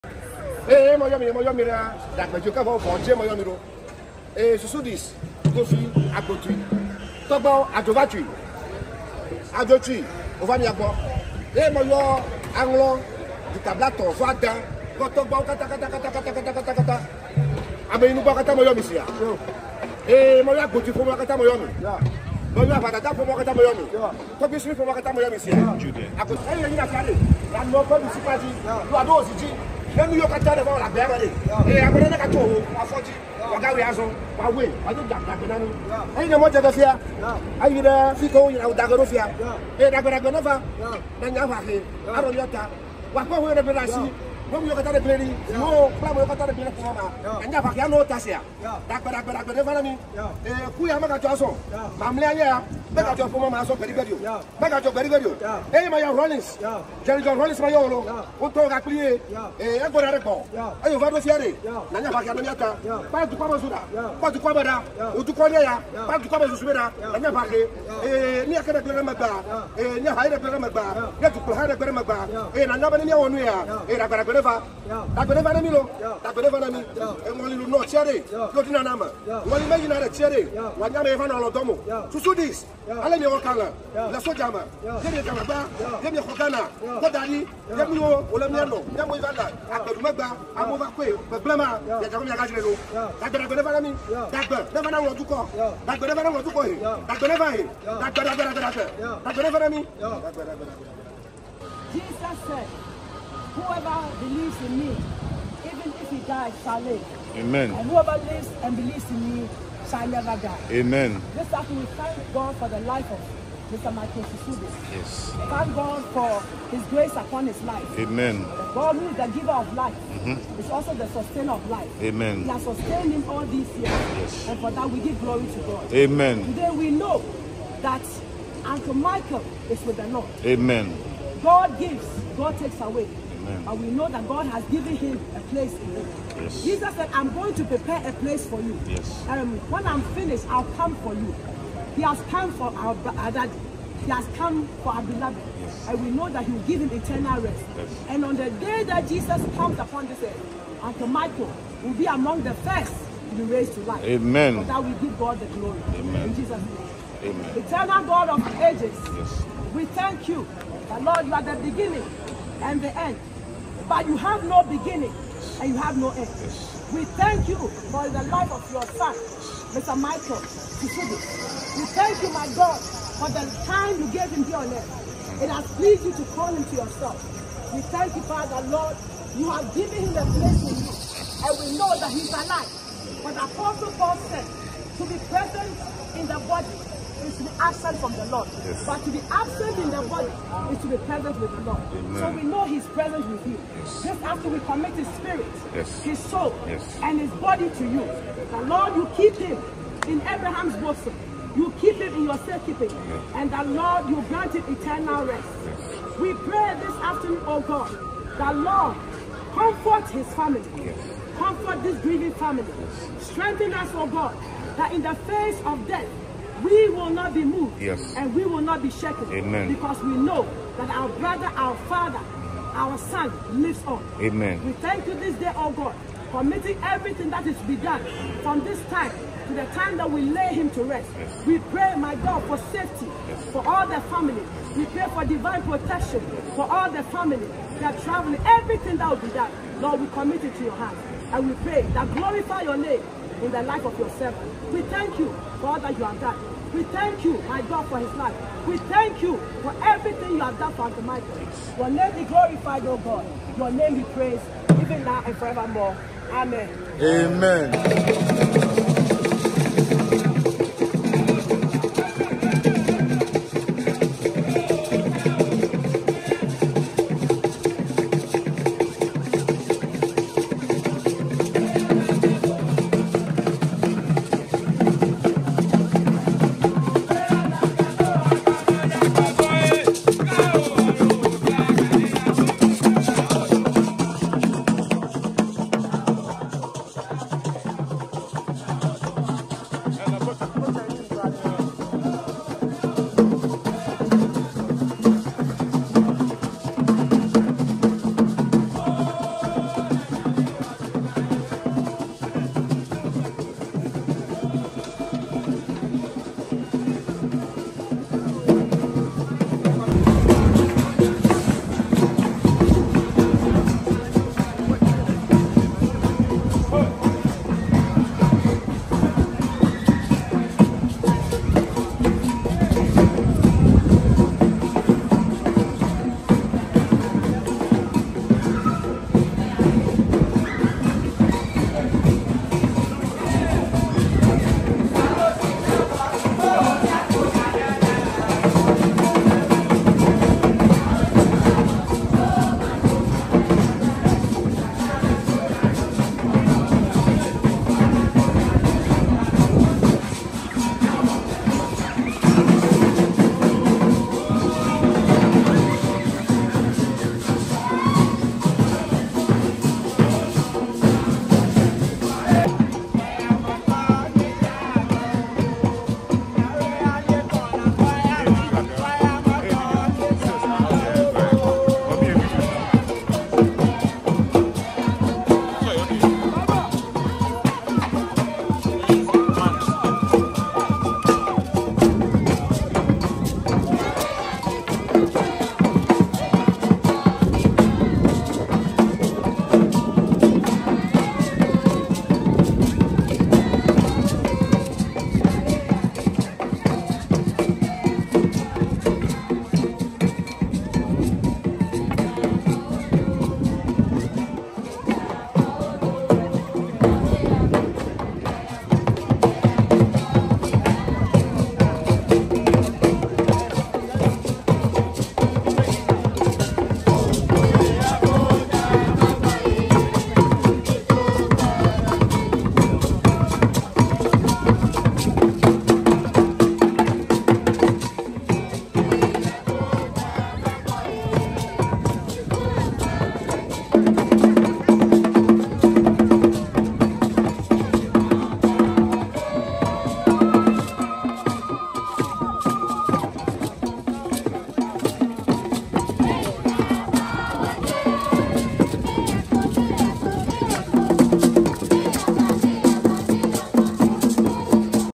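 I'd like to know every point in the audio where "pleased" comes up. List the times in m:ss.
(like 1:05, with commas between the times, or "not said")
2:55.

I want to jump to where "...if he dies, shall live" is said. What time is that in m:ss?
1:45.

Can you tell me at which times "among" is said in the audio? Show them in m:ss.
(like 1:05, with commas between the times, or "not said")
2:32.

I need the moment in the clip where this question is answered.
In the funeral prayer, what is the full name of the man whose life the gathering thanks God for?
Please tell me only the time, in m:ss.
1:53.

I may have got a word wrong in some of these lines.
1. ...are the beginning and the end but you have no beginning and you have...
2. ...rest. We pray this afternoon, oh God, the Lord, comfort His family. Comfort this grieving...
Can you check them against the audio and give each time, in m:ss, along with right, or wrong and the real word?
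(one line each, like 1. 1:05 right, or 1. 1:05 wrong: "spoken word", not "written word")
1. 2:41 right
2. 3:25 right.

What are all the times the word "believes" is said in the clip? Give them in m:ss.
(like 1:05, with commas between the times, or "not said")
1:44, 1:48.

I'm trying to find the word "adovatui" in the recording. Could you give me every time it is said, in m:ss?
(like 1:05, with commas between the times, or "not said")
0:07.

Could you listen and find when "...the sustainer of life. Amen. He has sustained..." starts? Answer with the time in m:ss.
2:00.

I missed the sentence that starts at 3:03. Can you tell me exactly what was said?
But the Apostle Paul said, to be present in the body is to be absent from the Lord.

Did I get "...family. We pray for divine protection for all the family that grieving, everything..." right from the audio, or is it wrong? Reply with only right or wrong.
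wrong.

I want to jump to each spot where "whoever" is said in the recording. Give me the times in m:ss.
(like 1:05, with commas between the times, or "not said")
1:43, 1:47.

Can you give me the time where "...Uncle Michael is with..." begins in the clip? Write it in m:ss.
2:08.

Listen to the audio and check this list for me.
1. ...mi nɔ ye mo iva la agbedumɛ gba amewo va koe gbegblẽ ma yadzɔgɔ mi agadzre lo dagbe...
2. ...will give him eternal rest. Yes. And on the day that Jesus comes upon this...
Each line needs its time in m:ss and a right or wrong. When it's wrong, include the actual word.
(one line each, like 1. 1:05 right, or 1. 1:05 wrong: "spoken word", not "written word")
1. 1:28 right
2. 2:26 right.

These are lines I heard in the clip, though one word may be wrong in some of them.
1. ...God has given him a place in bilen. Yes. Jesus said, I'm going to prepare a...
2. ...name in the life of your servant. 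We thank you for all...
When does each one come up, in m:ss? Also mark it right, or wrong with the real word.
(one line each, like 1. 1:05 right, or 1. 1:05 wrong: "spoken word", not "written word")
1. 2:14 wrong: "heaven", not "bilen"
2. 4:02 right.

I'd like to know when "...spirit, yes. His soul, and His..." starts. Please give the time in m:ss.
3:15.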